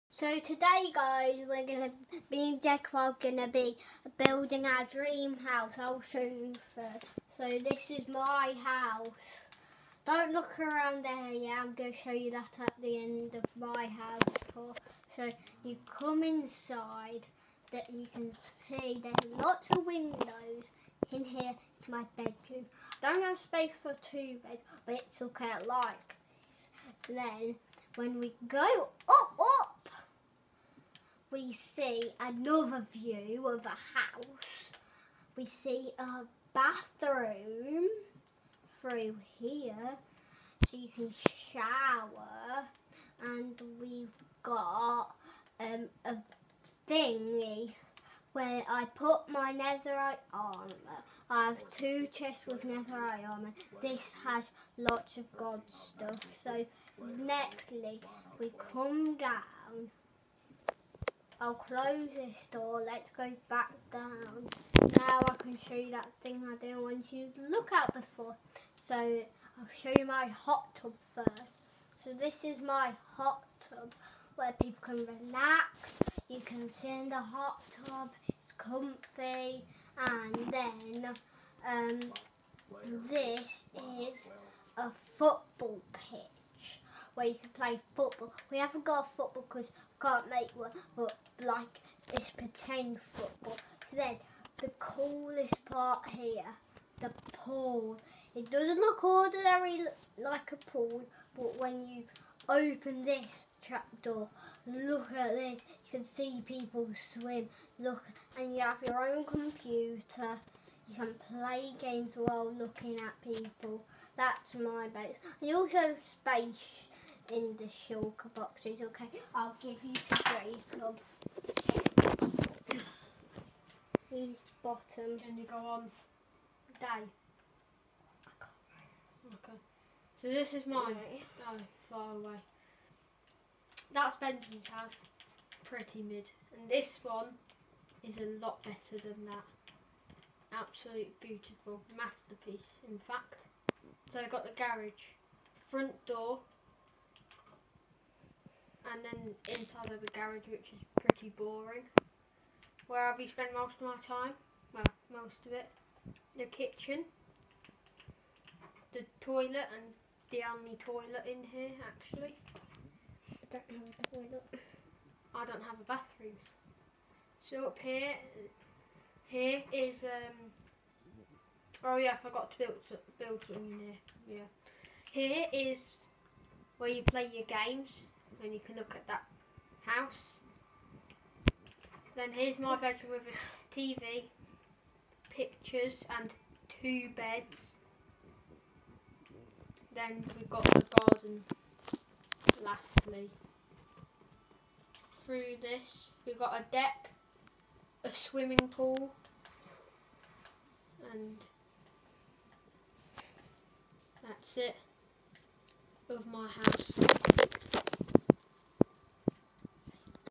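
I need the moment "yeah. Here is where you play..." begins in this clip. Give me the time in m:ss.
2:54.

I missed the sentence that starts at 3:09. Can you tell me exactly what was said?
Then we've got the garden lastly.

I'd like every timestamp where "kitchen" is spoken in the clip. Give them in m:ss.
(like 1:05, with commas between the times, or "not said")
2:36.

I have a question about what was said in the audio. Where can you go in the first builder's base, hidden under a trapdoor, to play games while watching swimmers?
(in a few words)
the pool.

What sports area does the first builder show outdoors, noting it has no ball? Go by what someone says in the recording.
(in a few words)
football pitch.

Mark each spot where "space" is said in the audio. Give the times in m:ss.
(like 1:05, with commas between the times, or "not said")
0:23, 1:56.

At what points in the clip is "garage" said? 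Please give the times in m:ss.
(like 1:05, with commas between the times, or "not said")
2:24, 2:30.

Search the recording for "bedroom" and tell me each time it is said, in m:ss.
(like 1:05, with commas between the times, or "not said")
0:22, 3:02.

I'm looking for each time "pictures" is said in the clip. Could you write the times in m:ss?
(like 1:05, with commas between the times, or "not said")
3:05.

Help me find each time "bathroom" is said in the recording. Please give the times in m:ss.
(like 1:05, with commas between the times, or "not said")
0:36, 2:45.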